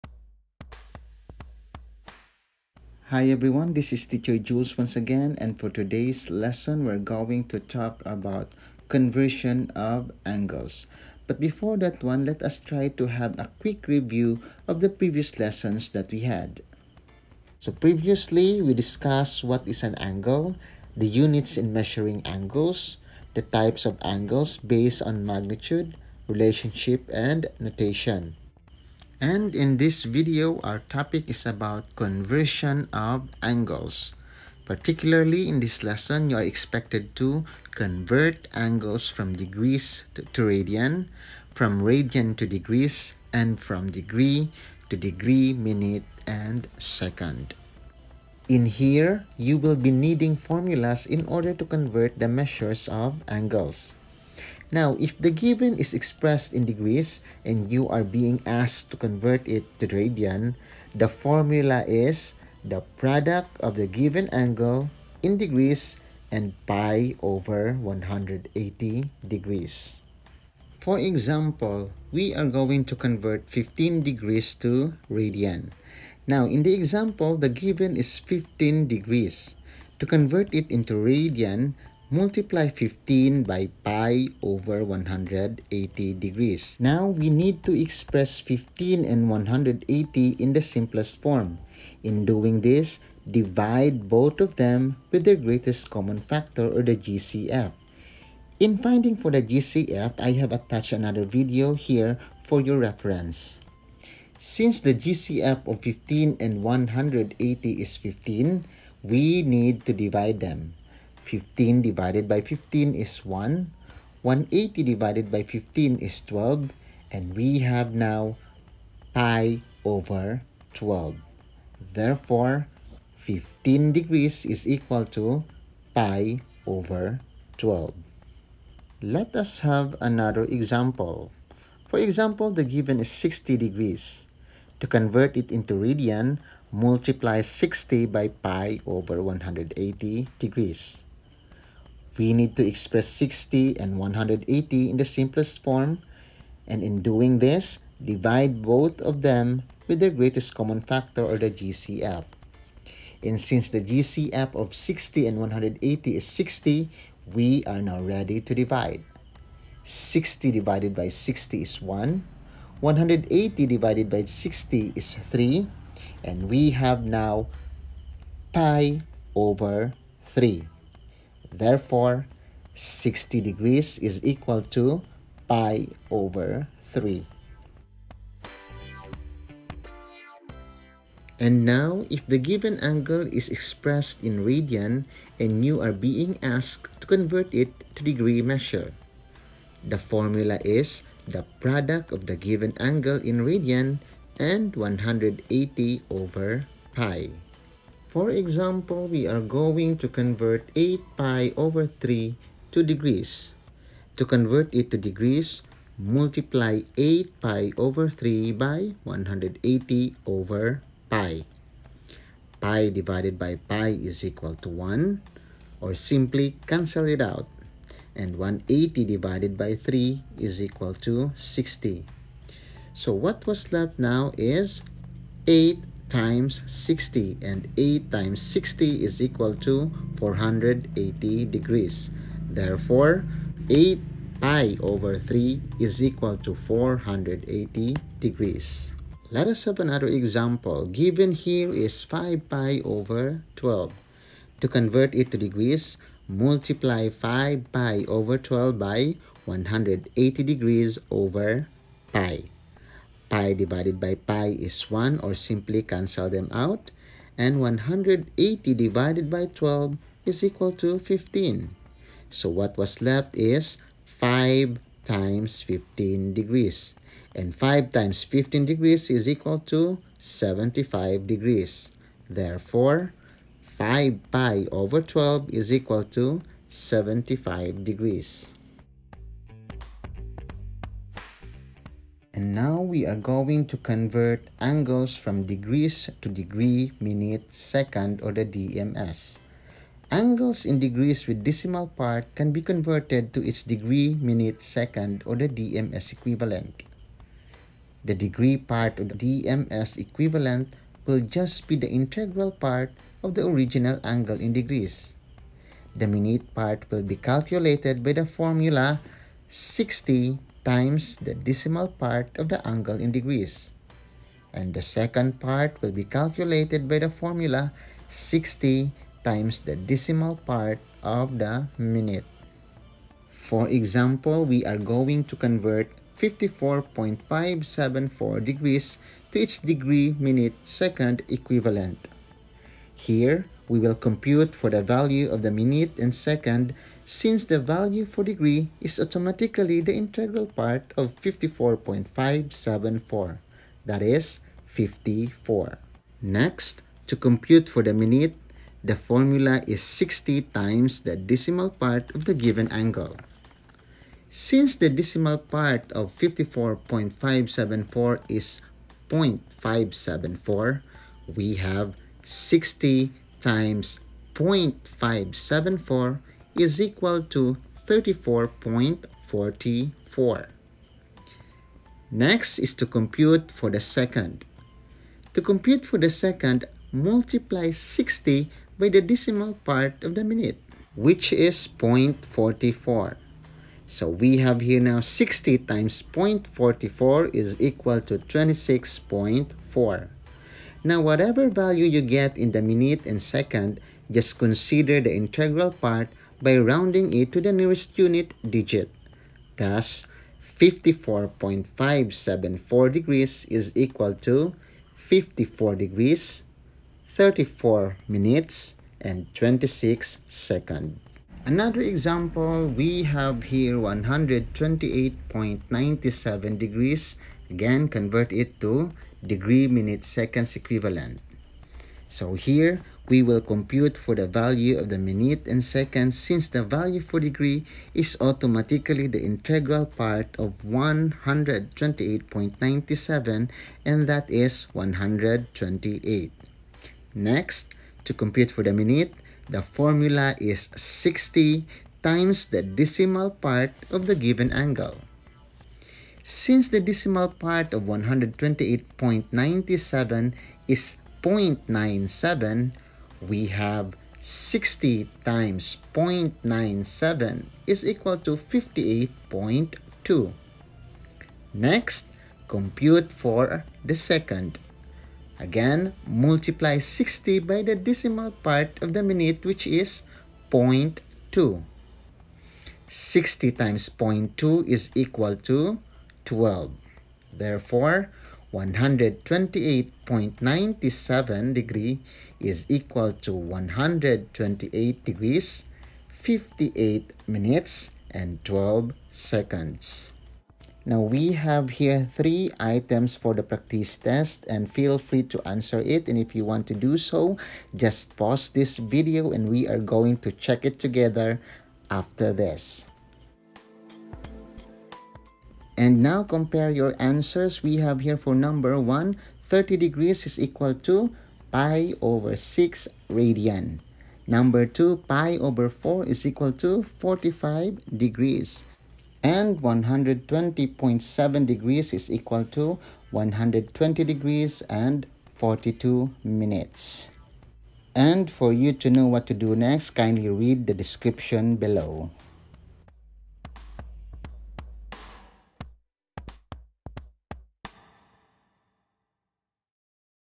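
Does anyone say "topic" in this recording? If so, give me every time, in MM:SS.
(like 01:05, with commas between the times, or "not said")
00:30.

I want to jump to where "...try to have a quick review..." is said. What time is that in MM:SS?
00:12.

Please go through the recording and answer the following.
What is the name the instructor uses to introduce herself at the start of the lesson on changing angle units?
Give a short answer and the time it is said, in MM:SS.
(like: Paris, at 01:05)
Julz, at 00:04.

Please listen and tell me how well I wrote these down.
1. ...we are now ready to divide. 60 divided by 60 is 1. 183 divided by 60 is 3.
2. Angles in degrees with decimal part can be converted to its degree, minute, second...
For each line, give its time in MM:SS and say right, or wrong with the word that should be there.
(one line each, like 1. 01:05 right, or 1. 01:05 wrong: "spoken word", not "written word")
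1. 02:37 wrong: "180", not "183"
2. 04:50 right.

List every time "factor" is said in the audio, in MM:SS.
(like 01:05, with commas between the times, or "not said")
01:36, 02:30.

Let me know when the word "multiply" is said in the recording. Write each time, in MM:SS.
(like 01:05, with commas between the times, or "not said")
01:22, 02:16, 03:25, 04:06, 06:16, 07:46.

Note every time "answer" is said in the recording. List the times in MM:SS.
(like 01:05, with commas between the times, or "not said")
08:15, 08:27.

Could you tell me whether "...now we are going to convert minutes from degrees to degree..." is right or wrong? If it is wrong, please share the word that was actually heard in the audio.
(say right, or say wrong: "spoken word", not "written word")
wrong: "angles", not "minutes".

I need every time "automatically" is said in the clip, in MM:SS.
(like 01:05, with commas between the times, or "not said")
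05:38, 07:08.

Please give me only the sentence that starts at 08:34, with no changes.
Number 2, pi over 4 is equal to 45 degrees.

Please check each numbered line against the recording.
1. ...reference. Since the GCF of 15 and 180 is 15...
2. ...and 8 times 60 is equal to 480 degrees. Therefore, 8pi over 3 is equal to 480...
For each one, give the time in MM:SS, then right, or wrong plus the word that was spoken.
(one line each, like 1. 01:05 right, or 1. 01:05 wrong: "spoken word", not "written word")
1. 01:42 right
2. 03:47 right.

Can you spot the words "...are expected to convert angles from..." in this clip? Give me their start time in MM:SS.
00:36.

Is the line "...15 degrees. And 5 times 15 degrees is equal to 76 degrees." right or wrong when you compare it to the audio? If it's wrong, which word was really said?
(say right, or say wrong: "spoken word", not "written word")
wrong: "75", not "76".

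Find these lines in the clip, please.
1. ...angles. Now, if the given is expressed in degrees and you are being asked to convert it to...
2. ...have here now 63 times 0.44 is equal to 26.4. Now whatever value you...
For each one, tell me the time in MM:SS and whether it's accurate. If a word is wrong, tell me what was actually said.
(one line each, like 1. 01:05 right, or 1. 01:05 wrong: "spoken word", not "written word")
1. 00:53 right
2. 06:24 wrong: "60", not "63".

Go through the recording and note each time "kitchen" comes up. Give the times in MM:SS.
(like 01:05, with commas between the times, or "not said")
not said.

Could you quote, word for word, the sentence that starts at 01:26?
Now, we need to express 15 and 180 in the simplest form.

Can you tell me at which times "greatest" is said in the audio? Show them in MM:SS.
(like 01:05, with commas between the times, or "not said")
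01:35, 02:30.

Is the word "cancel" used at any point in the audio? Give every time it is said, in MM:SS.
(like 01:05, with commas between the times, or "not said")
03:36, 04:15.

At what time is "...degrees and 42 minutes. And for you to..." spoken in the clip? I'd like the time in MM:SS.
08:44.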